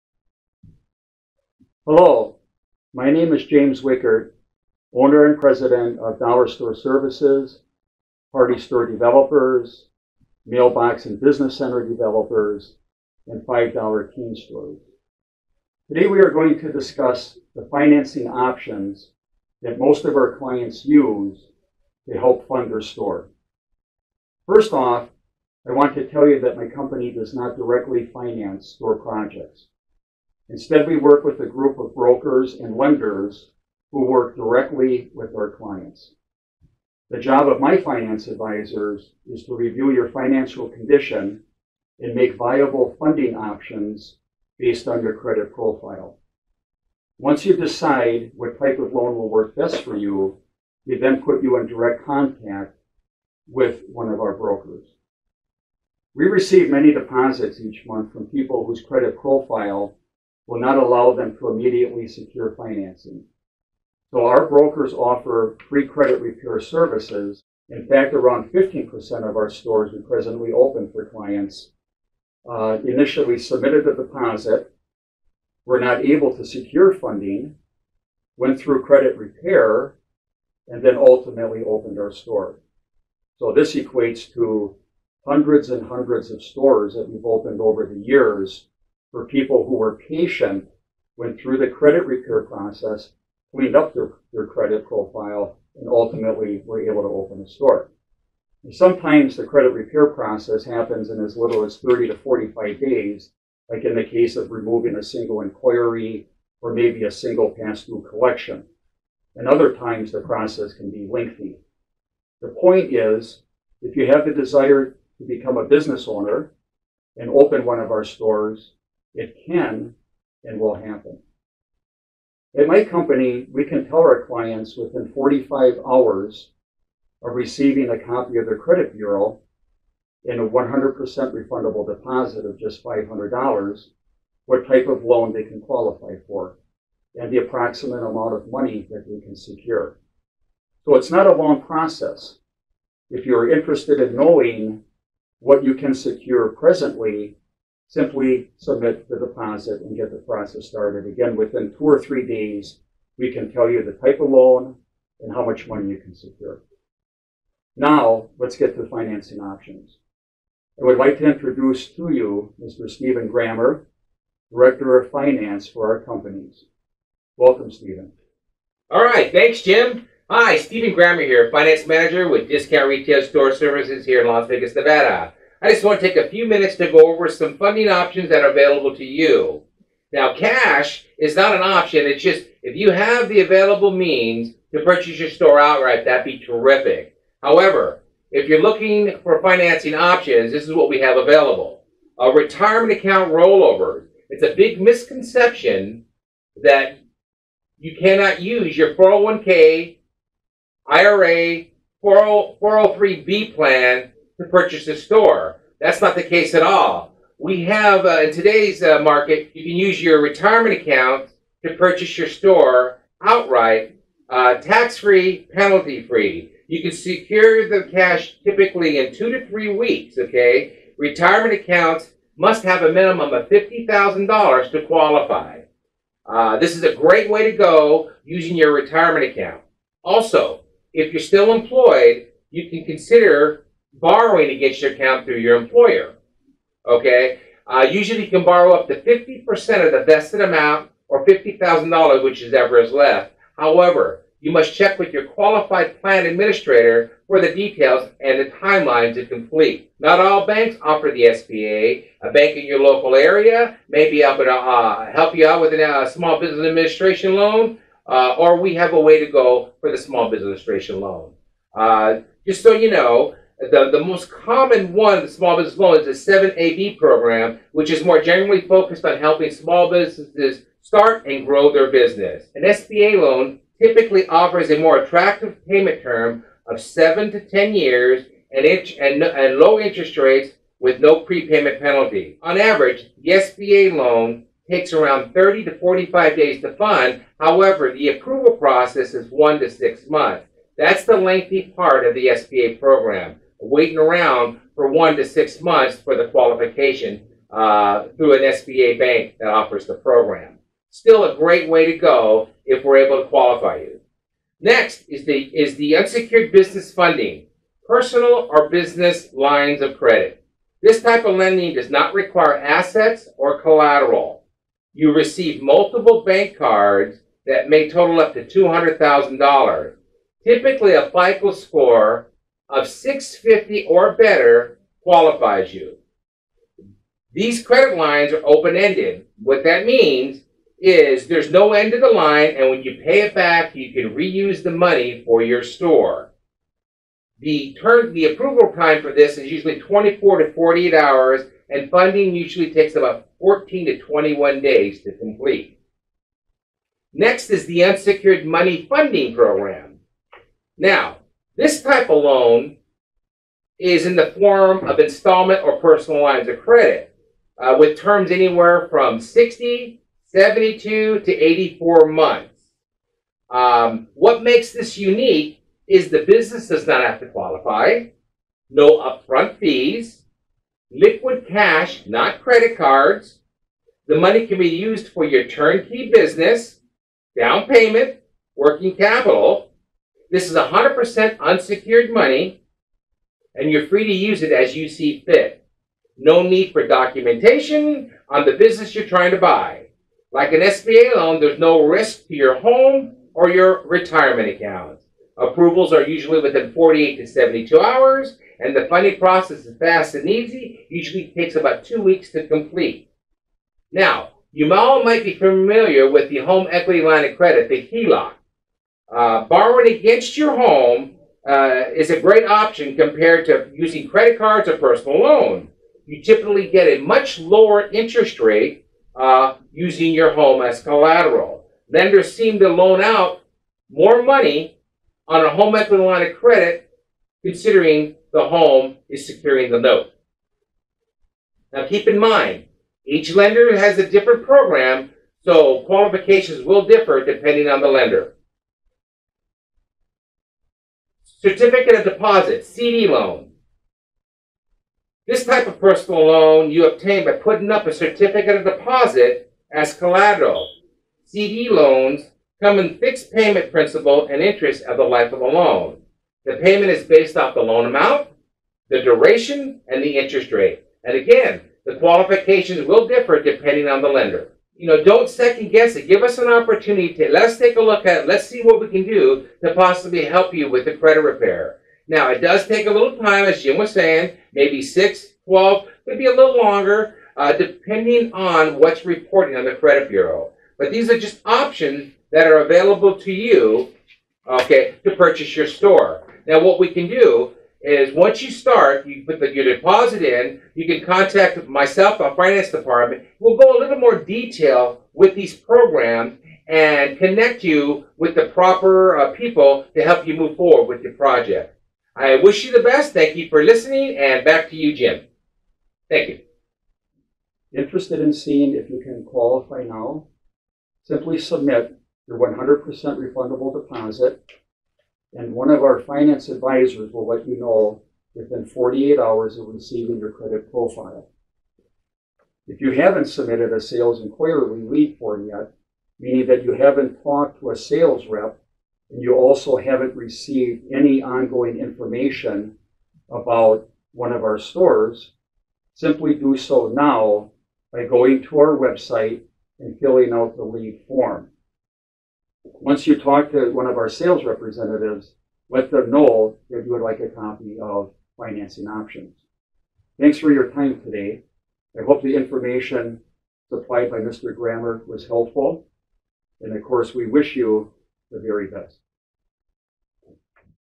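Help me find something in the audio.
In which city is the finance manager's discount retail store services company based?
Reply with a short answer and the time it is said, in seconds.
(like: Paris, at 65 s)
Las Vegas, at 174 s.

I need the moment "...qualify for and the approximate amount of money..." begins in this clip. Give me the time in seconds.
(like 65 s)
135 s.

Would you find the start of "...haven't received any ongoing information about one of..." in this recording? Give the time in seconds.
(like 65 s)
529 s.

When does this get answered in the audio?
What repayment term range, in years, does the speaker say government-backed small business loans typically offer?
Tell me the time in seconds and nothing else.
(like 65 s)
276 s.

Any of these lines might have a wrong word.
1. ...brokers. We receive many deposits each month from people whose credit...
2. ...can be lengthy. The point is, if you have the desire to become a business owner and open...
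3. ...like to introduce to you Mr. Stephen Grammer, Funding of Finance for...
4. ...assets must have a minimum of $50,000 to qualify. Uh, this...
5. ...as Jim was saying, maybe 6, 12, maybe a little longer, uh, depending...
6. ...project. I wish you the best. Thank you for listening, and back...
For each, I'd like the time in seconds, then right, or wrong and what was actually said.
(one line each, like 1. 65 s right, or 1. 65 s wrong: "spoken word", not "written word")
1. 54 s right
2. 110 s right
3. 160 s wrong: "Director", not "Funding"
4. 221 s wrong: "accounts", not "assets"
5. 473 s right
6. 501 s right.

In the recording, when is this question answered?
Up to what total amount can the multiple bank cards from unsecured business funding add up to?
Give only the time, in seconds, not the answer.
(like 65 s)
318 s.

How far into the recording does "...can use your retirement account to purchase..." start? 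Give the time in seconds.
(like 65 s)
209 s.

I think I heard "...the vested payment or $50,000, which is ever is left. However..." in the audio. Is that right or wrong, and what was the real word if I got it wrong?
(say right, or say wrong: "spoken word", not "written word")
wrong: "amount", not "payment".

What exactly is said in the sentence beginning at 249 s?
Not all banks offer the SBA.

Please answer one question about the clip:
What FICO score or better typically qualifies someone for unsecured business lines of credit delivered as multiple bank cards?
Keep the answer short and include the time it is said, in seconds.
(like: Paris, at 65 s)
650, at 322 s.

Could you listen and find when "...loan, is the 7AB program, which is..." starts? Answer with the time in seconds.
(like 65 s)
265 s.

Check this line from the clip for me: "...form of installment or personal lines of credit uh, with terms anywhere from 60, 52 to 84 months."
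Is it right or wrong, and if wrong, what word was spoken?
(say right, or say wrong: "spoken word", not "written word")
wrong: "72", not "52".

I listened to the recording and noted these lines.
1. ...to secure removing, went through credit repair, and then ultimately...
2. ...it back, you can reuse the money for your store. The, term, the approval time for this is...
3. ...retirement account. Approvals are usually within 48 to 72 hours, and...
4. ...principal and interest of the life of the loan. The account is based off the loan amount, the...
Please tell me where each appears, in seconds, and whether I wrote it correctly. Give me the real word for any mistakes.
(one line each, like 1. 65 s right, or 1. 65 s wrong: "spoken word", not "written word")
1. 76 s wrong: "funding", not "removing"
2. 333 s right
3. 393 s right
4. 453 s wrong: "payment", not "account".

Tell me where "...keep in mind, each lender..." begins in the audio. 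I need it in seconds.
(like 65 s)
431 s.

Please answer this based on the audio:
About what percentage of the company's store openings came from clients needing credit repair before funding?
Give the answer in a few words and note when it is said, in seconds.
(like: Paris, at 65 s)
15%, at 68 s.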